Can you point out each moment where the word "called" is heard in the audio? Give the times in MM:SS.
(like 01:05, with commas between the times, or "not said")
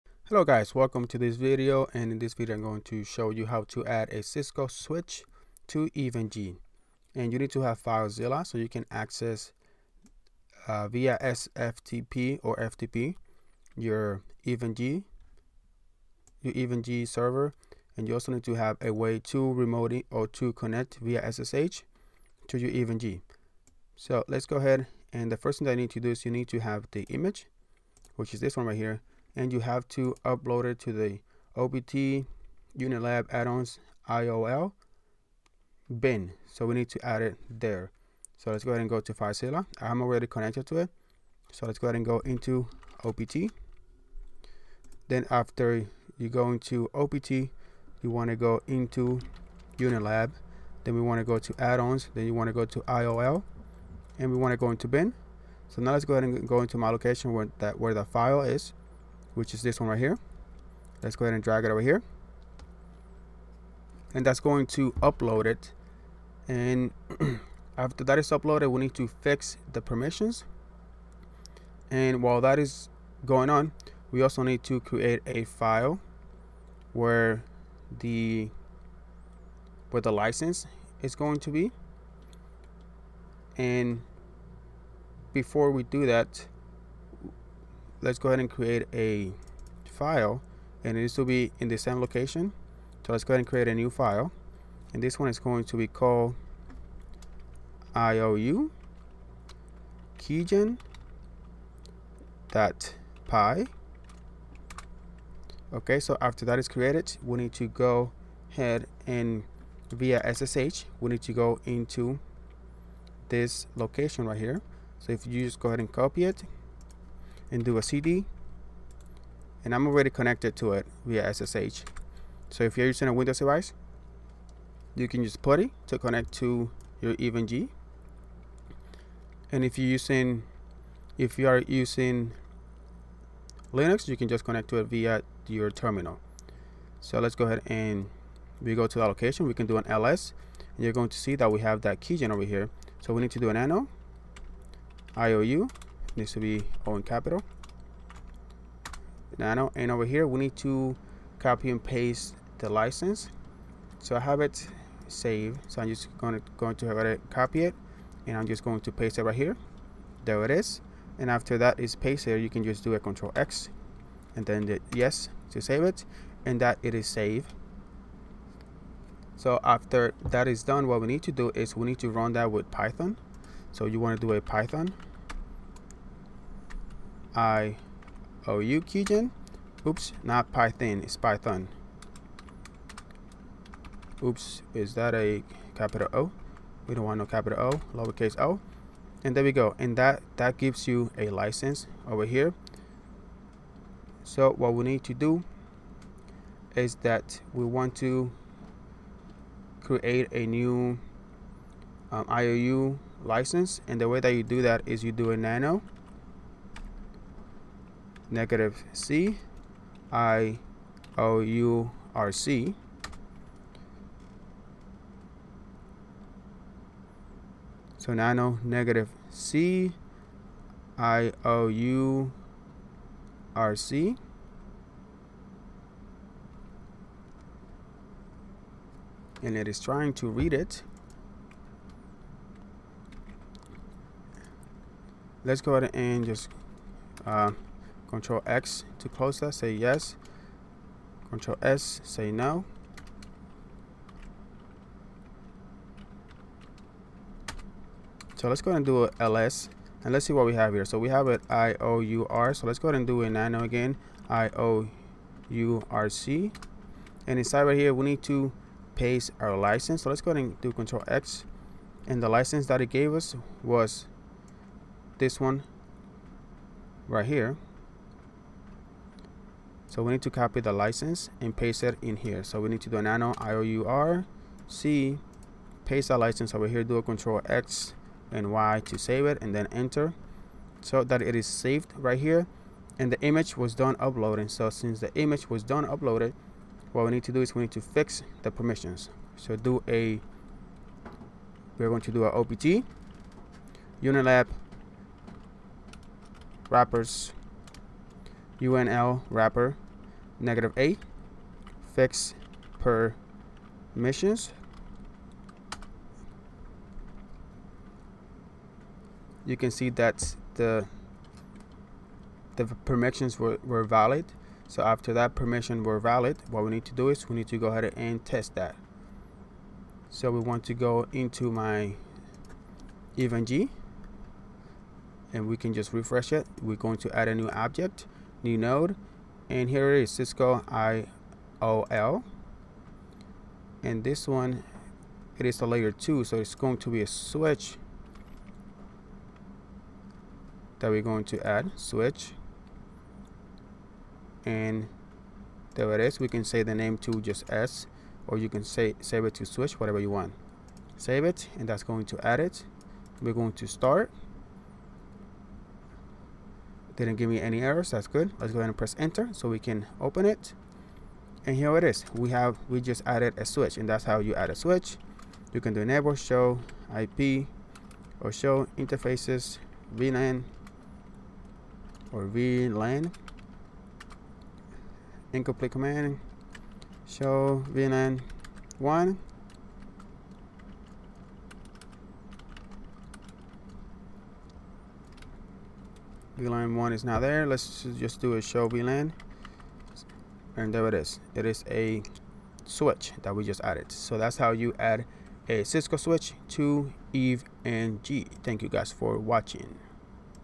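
01:35.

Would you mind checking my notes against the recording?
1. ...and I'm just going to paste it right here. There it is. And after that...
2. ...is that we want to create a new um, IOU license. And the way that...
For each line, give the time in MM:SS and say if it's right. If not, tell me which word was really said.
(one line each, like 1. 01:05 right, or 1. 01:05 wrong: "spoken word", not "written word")
1. 02:38 right
2. 03:16 right.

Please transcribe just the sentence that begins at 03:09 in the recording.
And that, that gives you a license over here.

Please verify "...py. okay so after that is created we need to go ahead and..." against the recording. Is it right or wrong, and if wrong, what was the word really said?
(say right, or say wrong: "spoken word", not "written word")
right.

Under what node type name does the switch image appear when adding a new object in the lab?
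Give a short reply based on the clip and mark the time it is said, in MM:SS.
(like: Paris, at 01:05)
Cisco IOL, at 05:30.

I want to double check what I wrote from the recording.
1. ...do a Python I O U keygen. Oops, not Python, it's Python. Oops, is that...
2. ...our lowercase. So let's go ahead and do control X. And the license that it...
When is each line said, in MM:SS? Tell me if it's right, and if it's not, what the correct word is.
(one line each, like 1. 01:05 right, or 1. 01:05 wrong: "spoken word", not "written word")
1. 02:54 right
2. 04:19 wrong: "license", not "lowercase".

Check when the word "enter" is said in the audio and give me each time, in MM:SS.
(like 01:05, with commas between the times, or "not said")
04:39, 05:58.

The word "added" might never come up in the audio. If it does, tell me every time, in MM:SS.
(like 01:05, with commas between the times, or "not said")
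06:03, 06:33.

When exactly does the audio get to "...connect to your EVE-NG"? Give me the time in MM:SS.
02:05.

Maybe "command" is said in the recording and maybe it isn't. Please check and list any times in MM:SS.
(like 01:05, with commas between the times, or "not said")
06:15.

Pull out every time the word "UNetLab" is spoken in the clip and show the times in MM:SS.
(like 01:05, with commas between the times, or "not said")
00:32, 00:49, 04:54.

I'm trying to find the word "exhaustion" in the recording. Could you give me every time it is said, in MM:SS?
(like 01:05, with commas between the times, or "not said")
not said.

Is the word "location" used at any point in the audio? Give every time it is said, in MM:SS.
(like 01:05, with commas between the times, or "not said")
00:56, 01:32, 01:53, 02:19.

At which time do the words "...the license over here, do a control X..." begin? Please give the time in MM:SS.
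04:36.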